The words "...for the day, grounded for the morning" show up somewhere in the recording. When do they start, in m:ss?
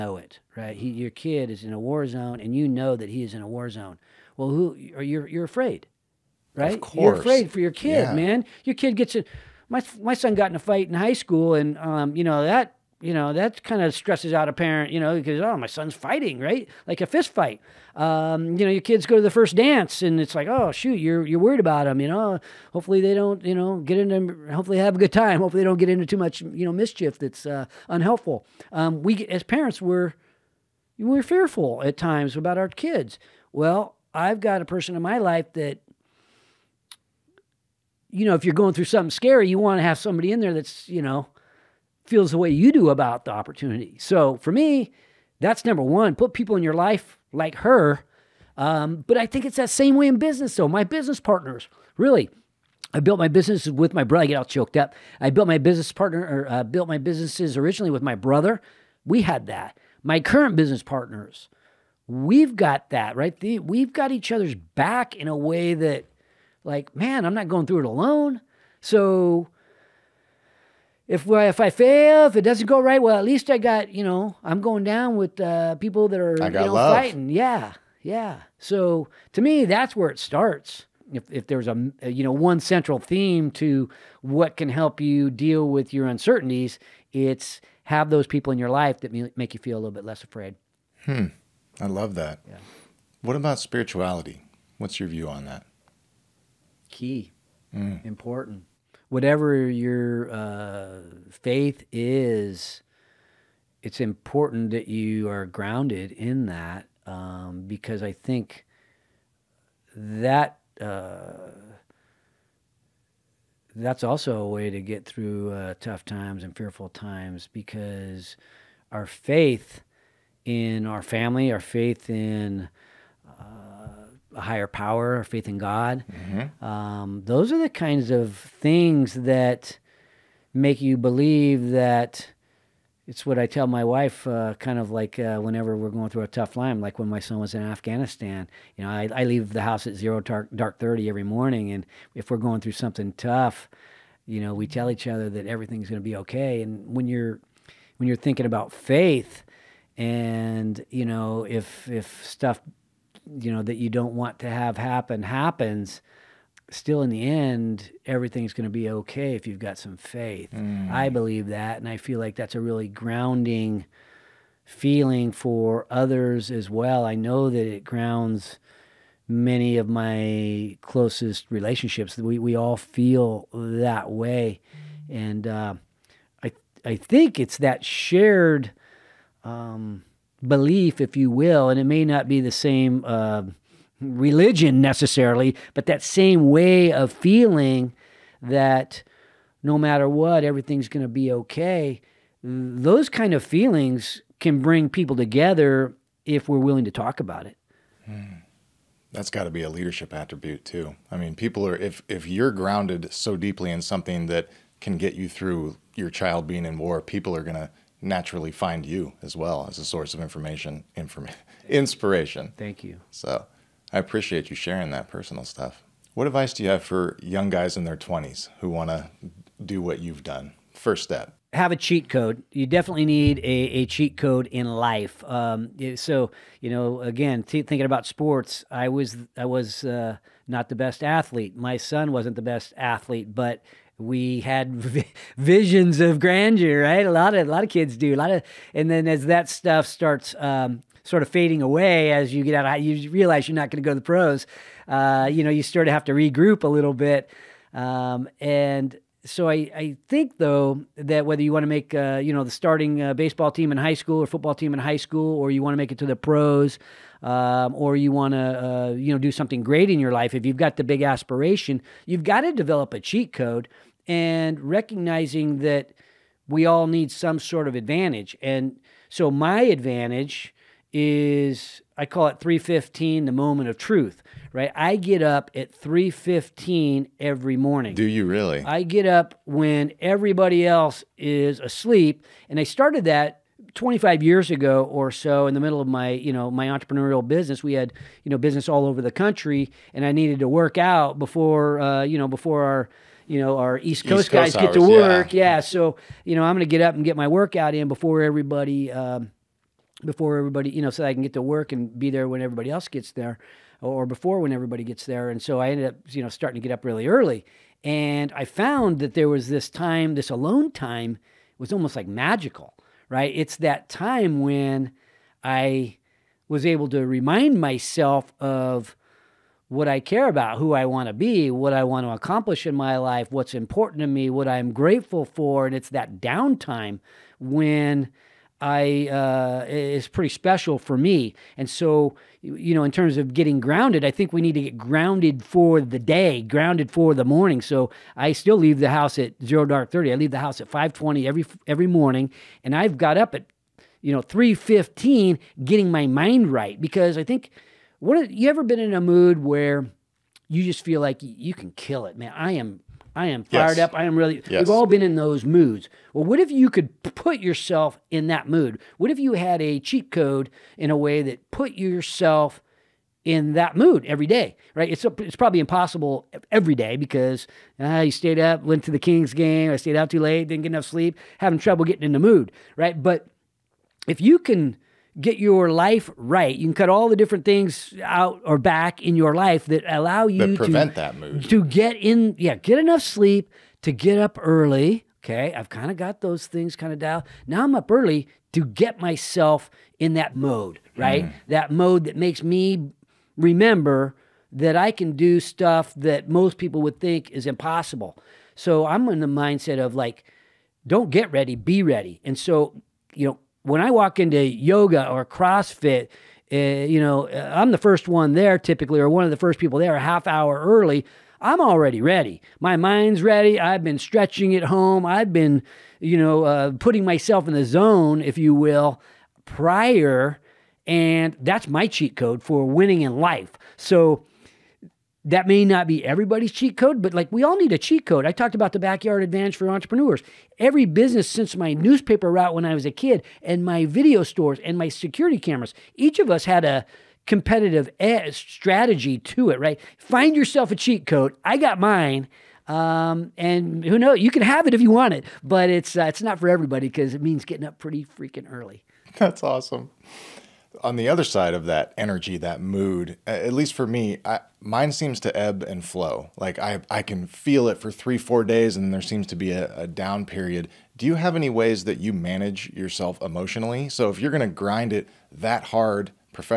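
5:35.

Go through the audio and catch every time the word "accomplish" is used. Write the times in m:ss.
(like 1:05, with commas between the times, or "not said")
5:22.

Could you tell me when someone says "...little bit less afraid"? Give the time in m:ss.
1:29.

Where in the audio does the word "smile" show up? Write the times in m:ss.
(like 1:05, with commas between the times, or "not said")
not said.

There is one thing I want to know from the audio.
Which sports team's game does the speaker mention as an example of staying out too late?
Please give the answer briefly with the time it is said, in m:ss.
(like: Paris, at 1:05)
The Kings, at 6:08.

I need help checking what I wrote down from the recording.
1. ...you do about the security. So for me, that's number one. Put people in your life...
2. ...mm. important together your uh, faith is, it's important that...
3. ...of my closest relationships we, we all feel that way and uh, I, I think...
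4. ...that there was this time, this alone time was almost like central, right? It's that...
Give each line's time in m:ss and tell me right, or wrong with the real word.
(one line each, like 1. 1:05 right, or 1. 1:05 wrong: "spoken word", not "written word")
1. 0:42 wrong: "opportunity", not "security"
2. 1:37 wrong: "whatever", not "together"
3. 2:49 right
4. 5:08 wrong: "magical", not "central".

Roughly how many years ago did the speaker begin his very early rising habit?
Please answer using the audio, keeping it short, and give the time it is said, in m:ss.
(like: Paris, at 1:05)
25 years, at 4:43.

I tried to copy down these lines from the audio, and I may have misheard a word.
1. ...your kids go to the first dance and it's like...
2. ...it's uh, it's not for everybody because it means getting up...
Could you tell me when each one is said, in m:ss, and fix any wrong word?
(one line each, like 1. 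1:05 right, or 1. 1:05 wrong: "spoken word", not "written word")
1. 0:18 right
2. 7:25 right.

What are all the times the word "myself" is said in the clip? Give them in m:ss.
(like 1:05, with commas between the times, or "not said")
5:17, 6:29, 6:57.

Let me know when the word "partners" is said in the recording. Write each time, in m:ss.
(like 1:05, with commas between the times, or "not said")
0:51, 0:55, 1:00.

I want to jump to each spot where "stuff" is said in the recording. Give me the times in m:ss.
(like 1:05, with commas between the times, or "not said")
2:32, 3:35, 3:59, 6:35.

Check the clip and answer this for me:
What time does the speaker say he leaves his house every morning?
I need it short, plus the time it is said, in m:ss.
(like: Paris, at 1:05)
5:20, at 5:40.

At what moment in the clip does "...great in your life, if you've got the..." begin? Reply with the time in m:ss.
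4:19.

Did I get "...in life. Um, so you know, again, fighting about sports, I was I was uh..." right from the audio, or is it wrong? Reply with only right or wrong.
wrong.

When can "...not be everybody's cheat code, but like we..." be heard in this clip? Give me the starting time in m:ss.
7:05.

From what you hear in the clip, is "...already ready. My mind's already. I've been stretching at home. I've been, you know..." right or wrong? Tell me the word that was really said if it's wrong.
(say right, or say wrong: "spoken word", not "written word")
wrong: "ready", not "already".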